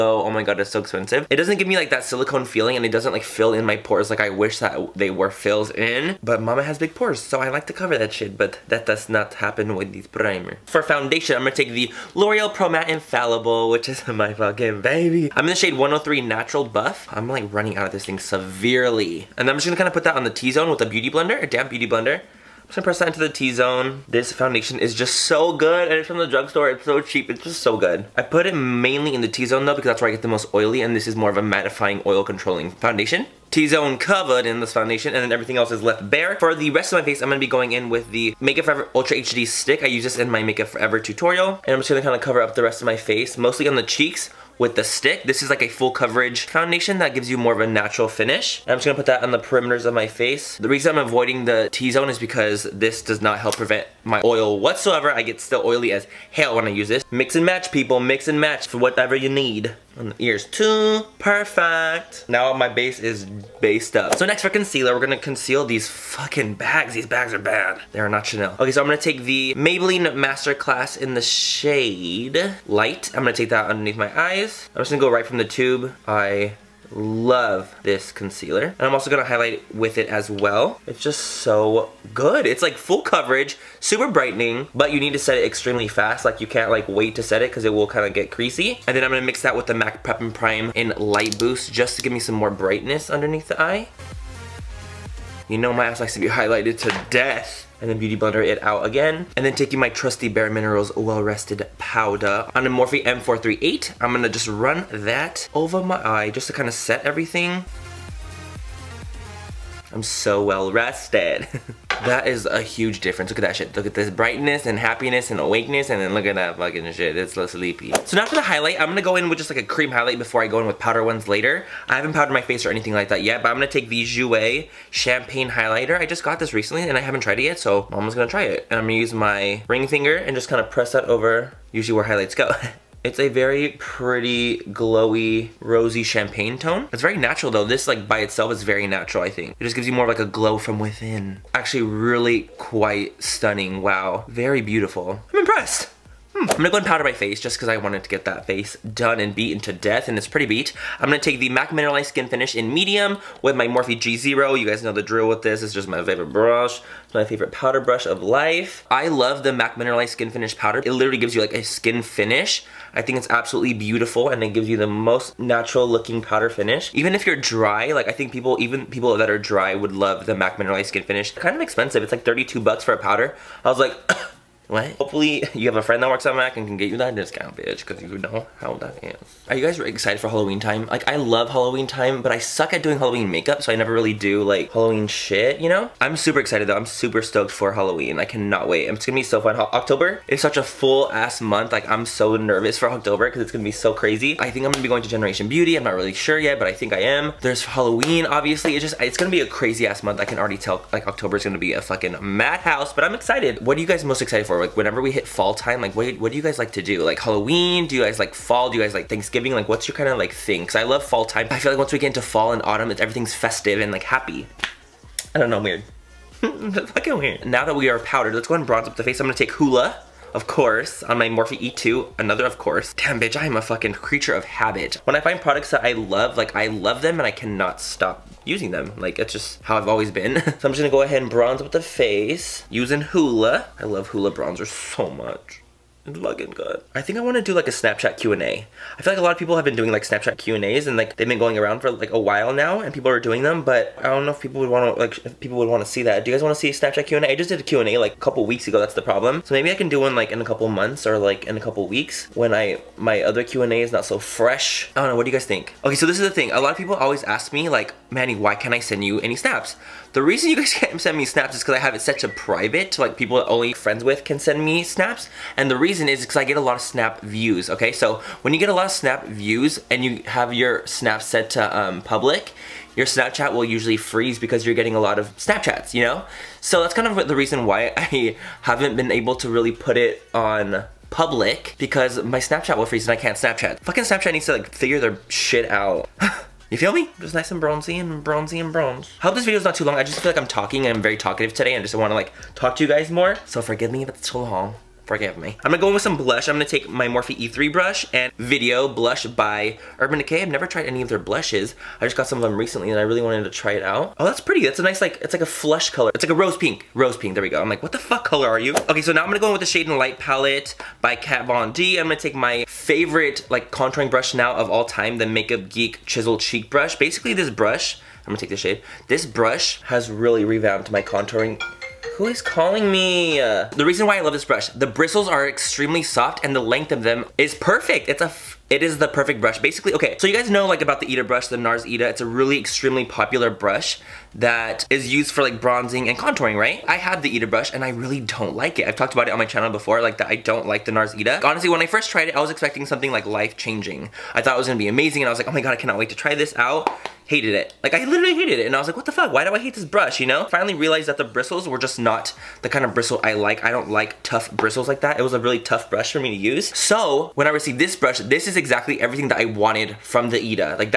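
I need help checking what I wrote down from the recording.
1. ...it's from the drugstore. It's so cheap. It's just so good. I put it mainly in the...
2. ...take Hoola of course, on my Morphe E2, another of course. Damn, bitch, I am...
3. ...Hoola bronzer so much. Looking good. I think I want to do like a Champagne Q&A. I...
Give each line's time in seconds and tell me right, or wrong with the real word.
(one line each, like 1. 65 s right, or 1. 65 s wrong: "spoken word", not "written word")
1. 25 s right
2. 219 s right
3. 234 s wrong: "Snapchat", not "Champagne".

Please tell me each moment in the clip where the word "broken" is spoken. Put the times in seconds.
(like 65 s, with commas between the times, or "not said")
not said.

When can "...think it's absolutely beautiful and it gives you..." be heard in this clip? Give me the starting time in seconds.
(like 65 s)
163 s.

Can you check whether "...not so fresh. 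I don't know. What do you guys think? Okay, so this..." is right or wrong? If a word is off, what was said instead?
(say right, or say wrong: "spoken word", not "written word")
right.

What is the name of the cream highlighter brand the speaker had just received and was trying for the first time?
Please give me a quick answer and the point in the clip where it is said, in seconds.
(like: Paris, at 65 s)
Jouer, at 124 s.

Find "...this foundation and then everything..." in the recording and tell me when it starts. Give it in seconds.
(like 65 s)
34 s.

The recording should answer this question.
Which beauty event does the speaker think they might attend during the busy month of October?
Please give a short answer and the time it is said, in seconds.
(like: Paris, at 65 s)
Generation Beauty, at 195 s.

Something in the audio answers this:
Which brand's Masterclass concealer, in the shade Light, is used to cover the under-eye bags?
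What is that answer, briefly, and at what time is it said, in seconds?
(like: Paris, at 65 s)
Maybelline, at 69 s.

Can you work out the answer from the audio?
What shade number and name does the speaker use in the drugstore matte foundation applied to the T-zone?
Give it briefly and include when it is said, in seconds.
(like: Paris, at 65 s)
103 Natural Buff, at 15 s.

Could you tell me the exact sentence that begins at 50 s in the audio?
The reason I'm avoiding the T-zone is because this does not help prevent my oil whatsoever.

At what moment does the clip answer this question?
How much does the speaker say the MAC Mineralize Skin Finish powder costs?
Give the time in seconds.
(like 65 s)
172 s.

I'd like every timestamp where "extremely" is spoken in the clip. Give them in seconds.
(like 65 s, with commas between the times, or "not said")
85 s, 325 s, 332 s.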